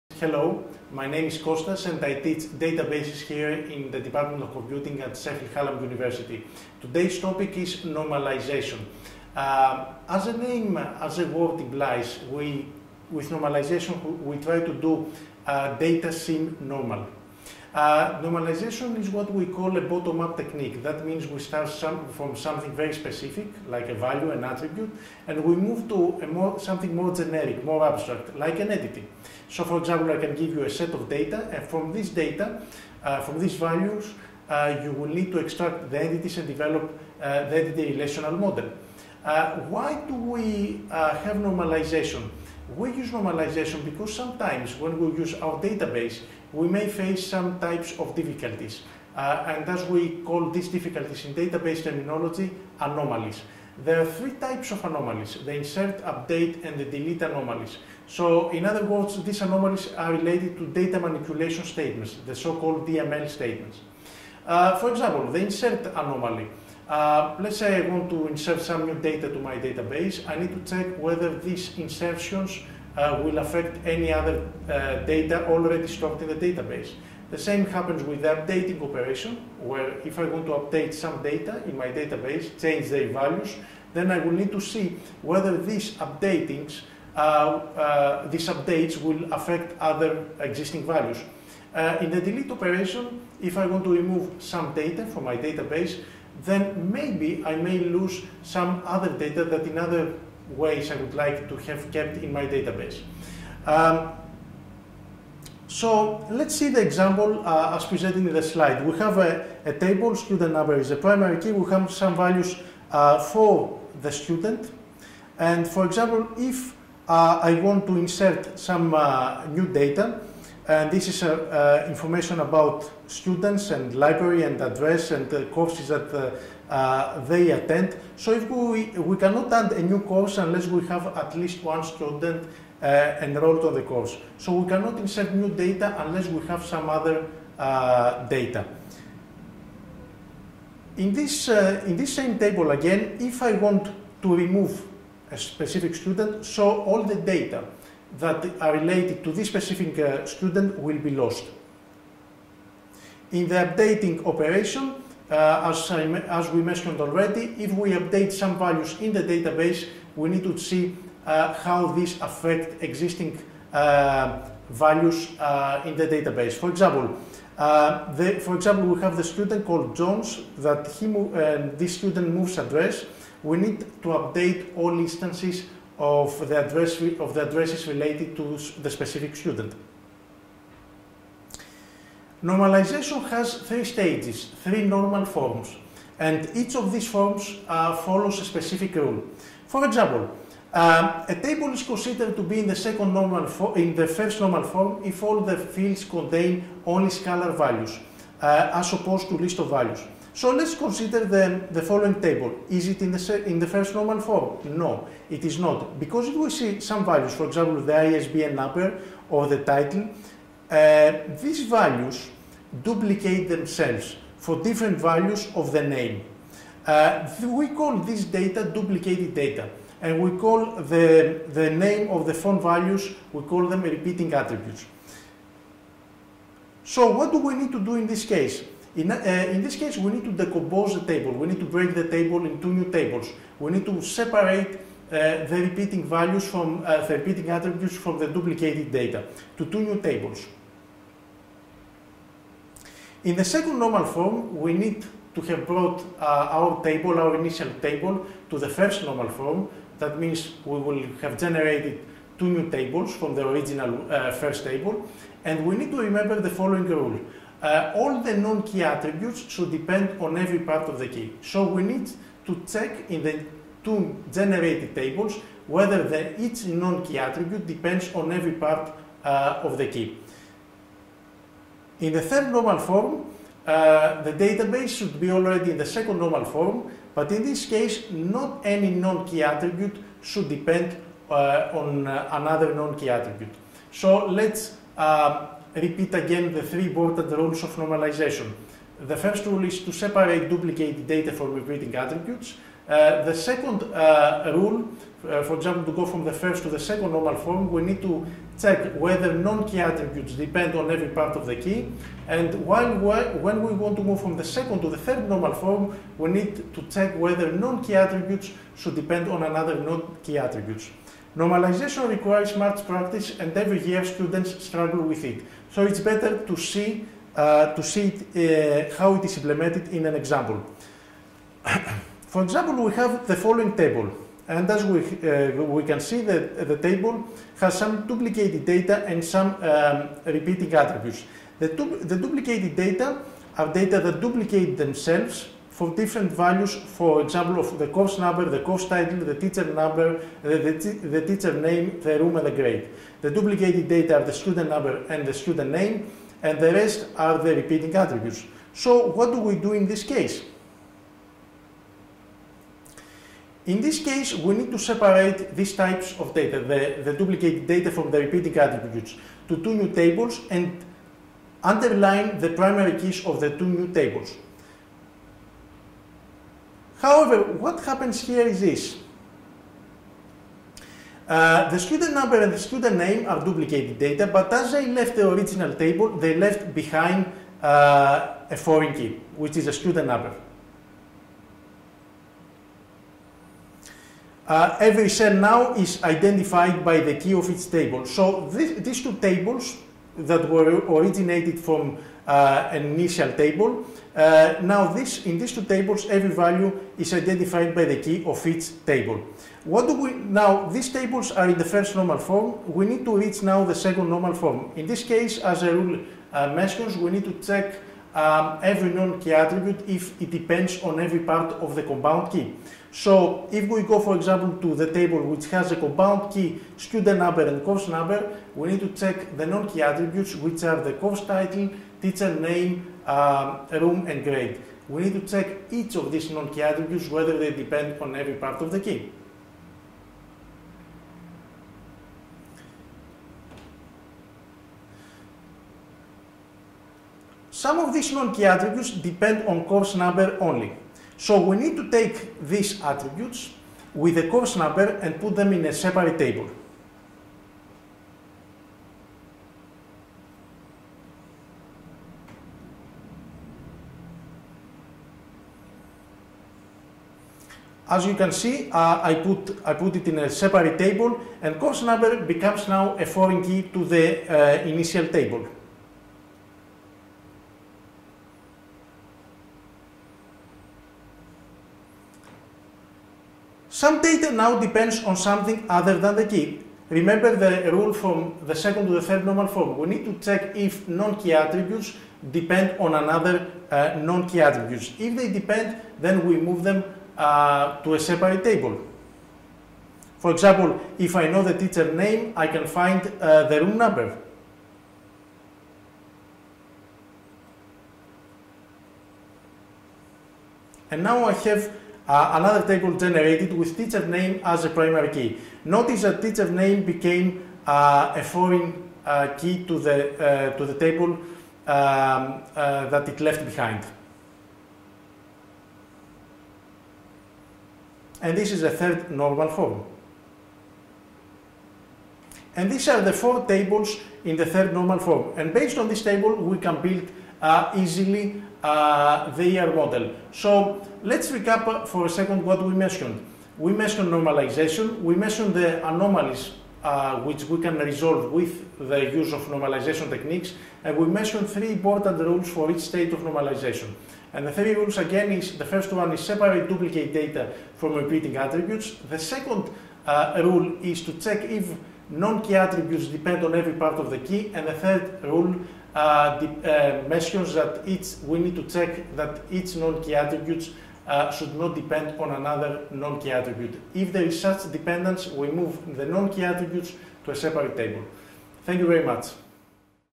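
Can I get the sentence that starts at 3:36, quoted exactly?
Uh, we call this data duplicated data and we call the, the name of the font values, we call them repeating attributes.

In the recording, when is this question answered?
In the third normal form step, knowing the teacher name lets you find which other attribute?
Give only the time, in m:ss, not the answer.
8:13.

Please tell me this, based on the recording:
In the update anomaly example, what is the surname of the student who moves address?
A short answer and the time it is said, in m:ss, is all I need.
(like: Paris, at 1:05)
Jones, at 2:49.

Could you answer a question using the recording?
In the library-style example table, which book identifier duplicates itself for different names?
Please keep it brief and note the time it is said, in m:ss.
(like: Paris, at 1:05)
ISBN number, at 3:27.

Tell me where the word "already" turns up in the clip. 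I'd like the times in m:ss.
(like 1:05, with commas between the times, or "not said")
1:15, 2:36, 4:35.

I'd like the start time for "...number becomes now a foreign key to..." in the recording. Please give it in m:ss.
7:41.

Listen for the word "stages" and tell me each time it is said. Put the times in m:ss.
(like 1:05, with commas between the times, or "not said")
3:03.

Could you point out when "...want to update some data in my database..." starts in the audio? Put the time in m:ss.
1:20.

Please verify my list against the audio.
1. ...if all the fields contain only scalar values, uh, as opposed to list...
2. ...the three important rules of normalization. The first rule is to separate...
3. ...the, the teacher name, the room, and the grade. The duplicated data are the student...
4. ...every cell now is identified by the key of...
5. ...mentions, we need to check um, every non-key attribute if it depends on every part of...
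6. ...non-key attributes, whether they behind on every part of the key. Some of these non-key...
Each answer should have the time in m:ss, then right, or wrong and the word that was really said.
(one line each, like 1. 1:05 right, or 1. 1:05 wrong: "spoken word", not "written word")
1. 3:15 right
2. 4:46 right
3. 5:40 right
4. 6:24 right
5. 6:46 right
6. 7:06 wrong: "depend", not "behind".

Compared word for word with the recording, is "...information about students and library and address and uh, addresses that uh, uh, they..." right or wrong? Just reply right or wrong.
wrong.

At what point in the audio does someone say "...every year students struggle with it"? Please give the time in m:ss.
5:13.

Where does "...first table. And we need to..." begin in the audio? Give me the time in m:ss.
4:14.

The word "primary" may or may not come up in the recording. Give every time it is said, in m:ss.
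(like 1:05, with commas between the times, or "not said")
1:50, 6:02, 8:24.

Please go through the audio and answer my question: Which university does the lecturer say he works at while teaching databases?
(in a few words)
Sheffield Hallam University.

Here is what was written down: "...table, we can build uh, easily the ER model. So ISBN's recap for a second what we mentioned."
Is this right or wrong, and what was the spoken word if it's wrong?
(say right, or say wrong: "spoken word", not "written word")
wrong: "Let", not "ISBN".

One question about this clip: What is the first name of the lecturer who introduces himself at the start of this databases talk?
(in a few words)
Kostas.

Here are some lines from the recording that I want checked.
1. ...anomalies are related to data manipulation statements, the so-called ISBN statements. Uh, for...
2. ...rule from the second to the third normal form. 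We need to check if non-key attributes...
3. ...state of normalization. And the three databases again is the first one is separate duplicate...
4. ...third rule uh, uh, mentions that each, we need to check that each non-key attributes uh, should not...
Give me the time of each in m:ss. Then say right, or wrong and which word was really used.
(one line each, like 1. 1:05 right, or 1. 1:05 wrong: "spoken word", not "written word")
1. 0:59 wrong: "DML", not "ISBN"
2. 7:57 right
3. 9:02 wrong: "rules", not "databases"
4. 9:14 right.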